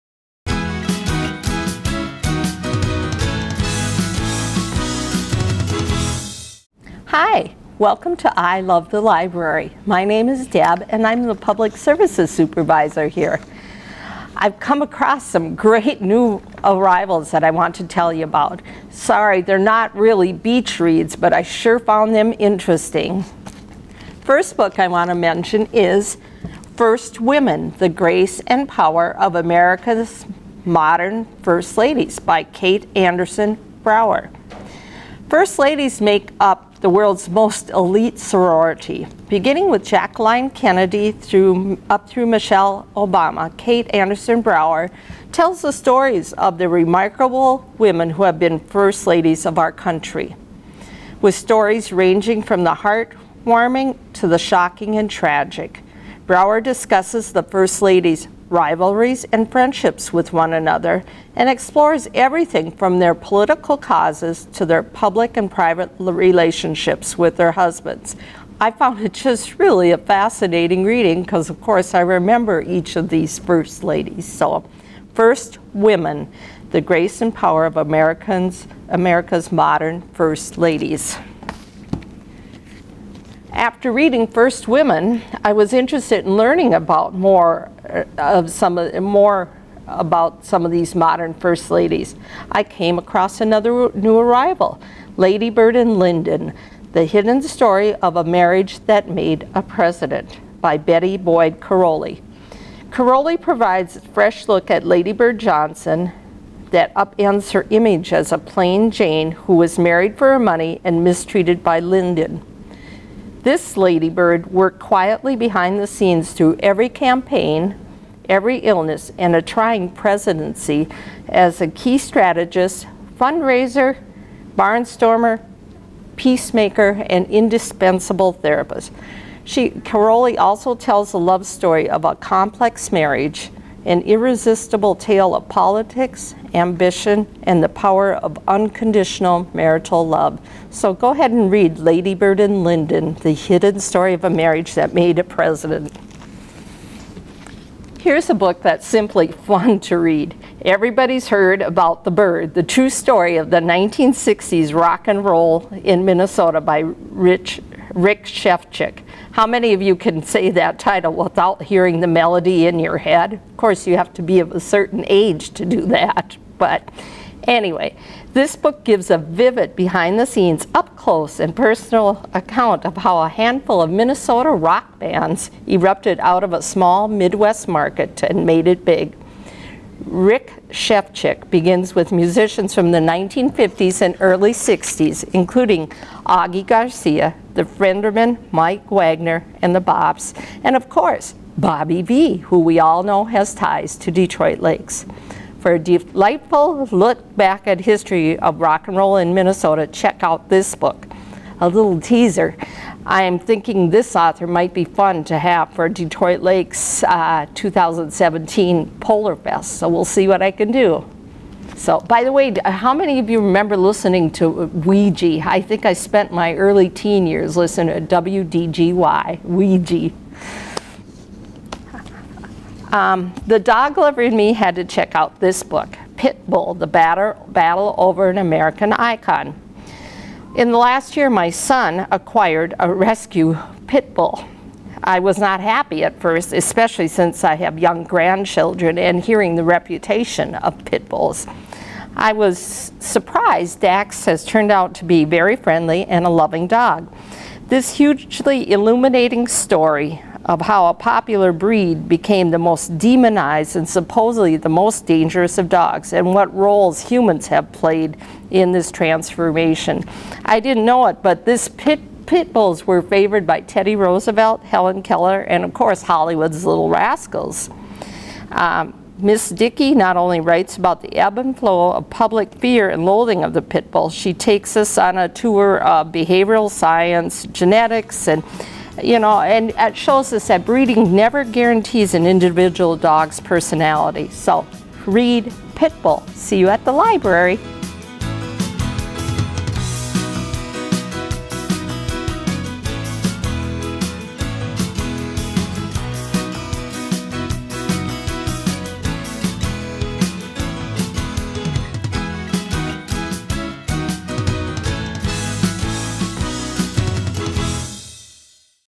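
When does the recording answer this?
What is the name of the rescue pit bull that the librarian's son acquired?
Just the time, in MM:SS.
04:03.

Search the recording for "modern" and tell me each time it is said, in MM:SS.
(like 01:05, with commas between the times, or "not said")
00:30, 01:19, 01:30.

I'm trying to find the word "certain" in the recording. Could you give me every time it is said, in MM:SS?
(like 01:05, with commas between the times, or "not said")
02:44.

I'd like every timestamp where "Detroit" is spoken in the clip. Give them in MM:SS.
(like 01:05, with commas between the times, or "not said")
03:14, 03:25.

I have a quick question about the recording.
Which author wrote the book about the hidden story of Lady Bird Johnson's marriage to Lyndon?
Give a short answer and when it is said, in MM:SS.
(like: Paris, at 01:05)
Betty Boyd Caroli, at 01:40.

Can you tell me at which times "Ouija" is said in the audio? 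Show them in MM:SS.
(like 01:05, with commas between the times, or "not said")
03:34, 03:39.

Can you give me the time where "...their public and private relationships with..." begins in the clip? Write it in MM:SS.
01:04.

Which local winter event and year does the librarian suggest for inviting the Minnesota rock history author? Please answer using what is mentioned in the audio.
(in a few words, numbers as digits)
2017 Polar Fest.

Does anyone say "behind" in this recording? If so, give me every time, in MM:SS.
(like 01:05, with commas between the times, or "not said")
01:55, 02:49.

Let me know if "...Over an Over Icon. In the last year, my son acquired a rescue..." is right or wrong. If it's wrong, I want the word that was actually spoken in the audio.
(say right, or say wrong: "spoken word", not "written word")
wrong: "American", not "Over".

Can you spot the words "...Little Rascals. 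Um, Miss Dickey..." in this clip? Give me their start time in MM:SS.
04:26.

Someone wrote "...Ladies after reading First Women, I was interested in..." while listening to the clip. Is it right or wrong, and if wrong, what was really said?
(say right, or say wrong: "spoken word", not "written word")
right.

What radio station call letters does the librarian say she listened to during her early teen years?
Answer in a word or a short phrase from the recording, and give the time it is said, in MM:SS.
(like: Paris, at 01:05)
WDGY, at 03:38.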